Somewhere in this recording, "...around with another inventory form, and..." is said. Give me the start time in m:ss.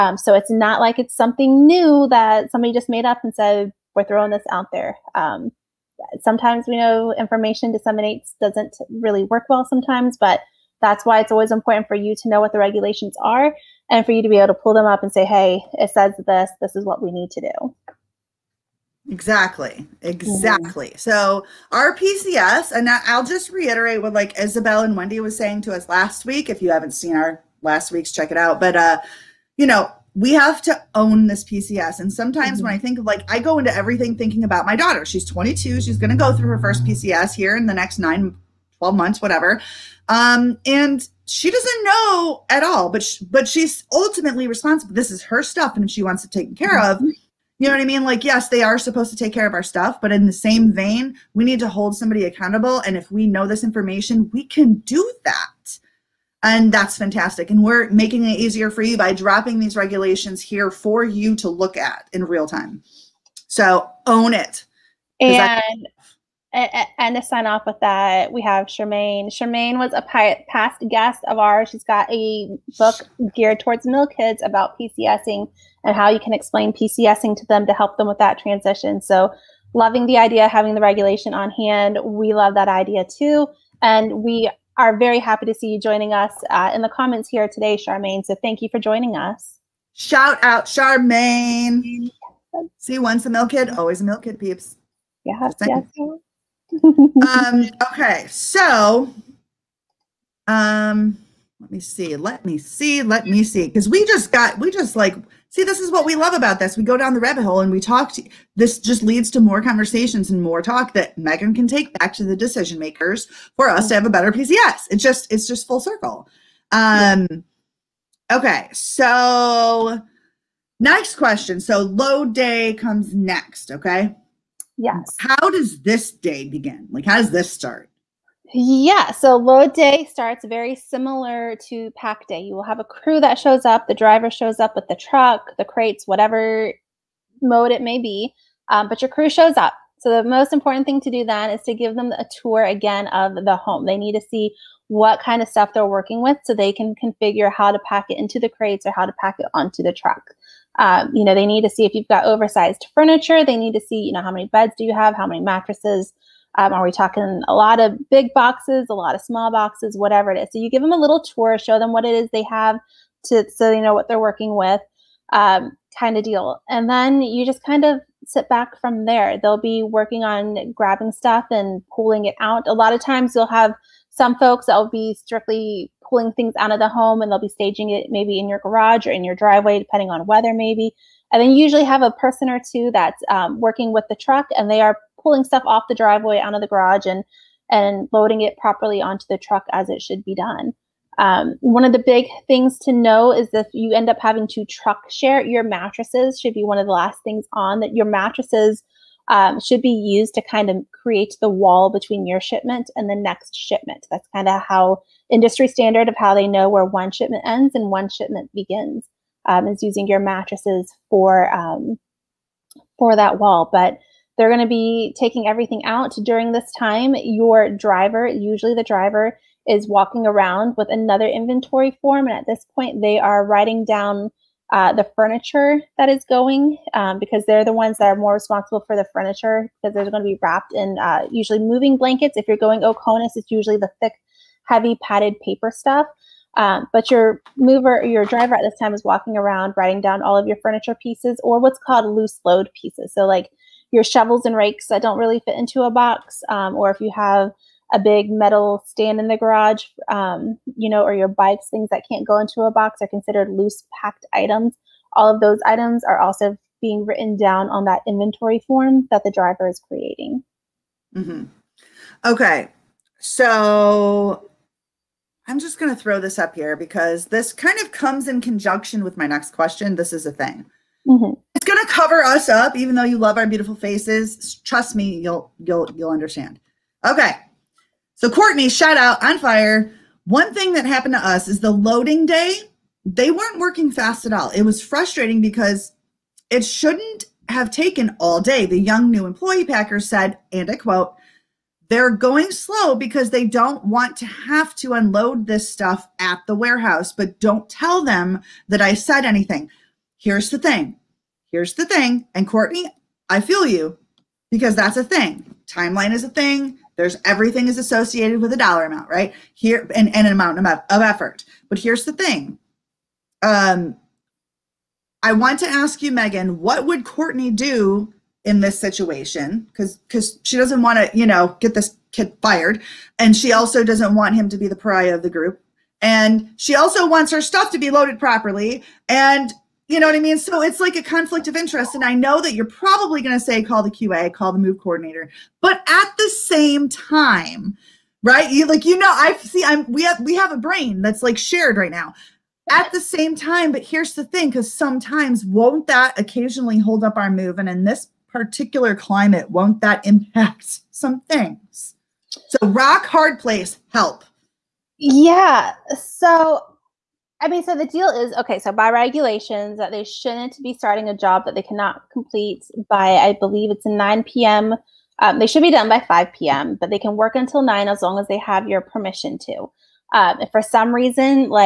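3:40.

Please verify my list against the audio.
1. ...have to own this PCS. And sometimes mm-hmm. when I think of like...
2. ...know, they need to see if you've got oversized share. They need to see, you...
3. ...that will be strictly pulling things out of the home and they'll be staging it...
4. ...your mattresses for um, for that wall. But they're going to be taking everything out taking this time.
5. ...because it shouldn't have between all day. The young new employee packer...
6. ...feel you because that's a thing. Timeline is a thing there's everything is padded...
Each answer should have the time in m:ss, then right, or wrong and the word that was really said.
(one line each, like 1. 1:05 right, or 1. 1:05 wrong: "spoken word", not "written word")
1. 0:30 right
2. 2:31 wrong: "furniture", not "share"
3. 2:54 right
4. 3:30 wrong: "during", not "taking"
5. 4:45 wrong: "taken", not "between"
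6. 5:03 wrong: "associated", not "padded".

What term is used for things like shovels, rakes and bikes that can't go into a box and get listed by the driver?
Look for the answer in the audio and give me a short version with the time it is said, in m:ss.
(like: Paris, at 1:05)
Loose load pieces, at 4:02.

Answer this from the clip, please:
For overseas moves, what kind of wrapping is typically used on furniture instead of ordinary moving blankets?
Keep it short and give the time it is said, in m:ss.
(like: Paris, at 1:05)
Thick, heavy padded paper, at 3:54.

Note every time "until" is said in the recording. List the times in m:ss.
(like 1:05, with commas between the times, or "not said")
6:07.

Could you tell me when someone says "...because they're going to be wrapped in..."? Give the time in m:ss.
3:49.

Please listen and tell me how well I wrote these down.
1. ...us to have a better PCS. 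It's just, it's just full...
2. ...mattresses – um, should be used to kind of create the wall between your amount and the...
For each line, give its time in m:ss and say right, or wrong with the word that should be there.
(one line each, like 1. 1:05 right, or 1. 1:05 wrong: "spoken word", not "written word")
1. 1:53 right
2. 3:18 wrong: "shipment", not "amount".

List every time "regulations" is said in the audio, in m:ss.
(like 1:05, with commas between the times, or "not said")
0:12, 0:59, 1:20, 5:58.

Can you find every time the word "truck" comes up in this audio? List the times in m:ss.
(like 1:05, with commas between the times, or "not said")
2:14, 2:29, 3:04, 3:09, 3:14.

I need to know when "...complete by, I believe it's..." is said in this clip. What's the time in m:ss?
6:02.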